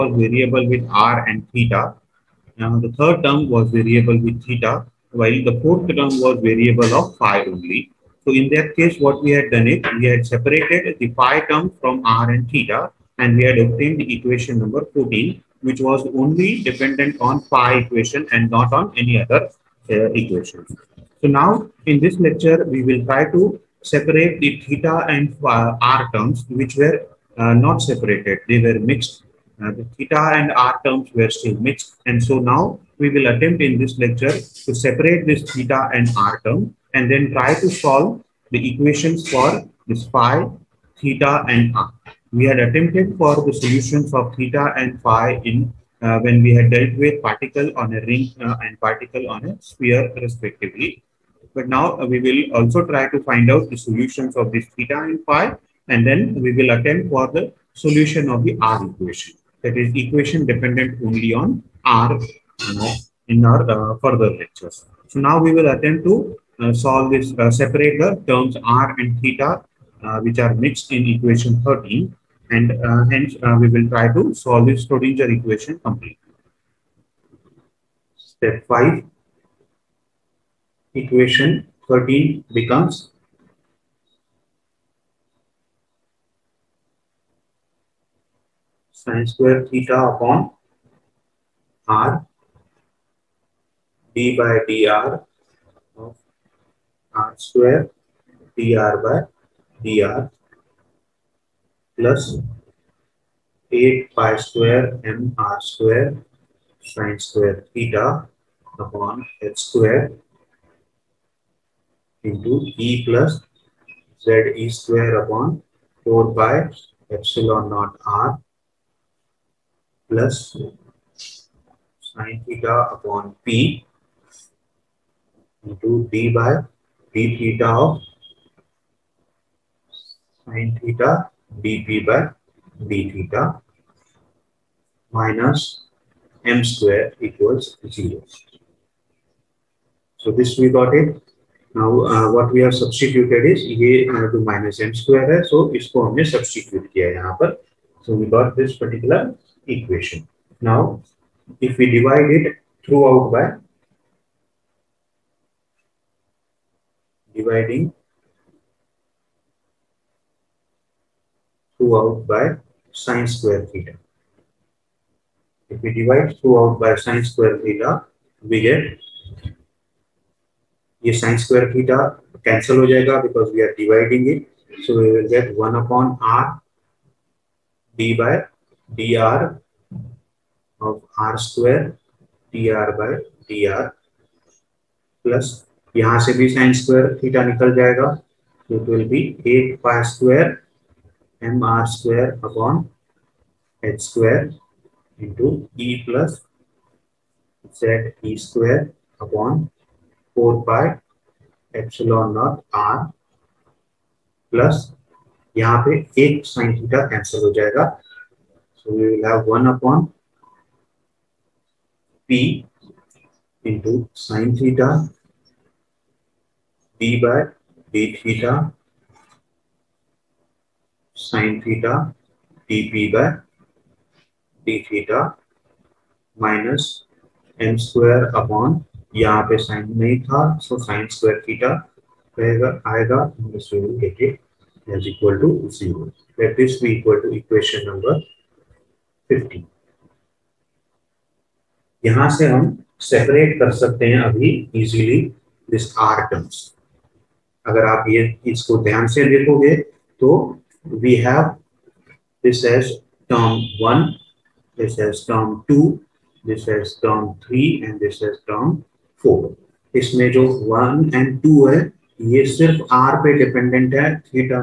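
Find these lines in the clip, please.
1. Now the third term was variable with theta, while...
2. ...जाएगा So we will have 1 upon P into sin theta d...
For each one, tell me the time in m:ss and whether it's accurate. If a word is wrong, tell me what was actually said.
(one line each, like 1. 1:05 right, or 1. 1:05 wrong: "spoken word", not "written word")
1. 0:02 right
2. 3:27 right.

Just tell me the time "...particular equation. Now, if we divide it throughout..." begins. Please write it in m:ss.
2:28.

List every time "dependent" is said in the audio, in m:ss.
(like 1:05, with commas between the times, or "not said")
0:16, 1:00.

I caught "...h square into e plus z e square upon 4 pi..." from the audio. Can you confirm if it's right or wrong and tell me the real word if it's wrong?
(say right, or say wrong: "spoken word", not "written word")
right.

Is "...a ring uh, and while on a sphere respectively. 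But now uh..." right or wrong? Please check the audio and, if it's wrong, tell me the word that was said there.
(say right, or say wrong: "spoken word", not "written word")
wrong: "particle", not "while".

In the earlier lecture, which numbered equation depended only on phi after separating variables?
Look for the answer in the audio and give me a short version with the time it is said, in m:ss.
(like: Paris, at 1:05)
14, at 0:14.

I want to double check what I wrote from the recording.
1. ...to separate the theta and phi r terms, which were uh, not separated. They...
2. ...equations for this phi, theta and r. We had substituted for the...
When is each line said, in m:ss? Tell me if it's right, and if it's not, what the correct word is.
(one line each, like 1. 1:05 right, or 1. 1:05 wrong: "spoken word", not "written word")
1. 0:23 right
2. 0:38 wrong: "attempted", not "substituted".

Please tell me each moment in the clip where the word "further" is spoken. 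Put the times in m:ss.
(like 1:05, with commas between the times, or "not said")
1:04.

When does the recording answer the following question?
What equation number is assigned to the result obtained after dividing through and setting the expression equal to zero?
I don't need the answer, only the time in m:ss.
3:57.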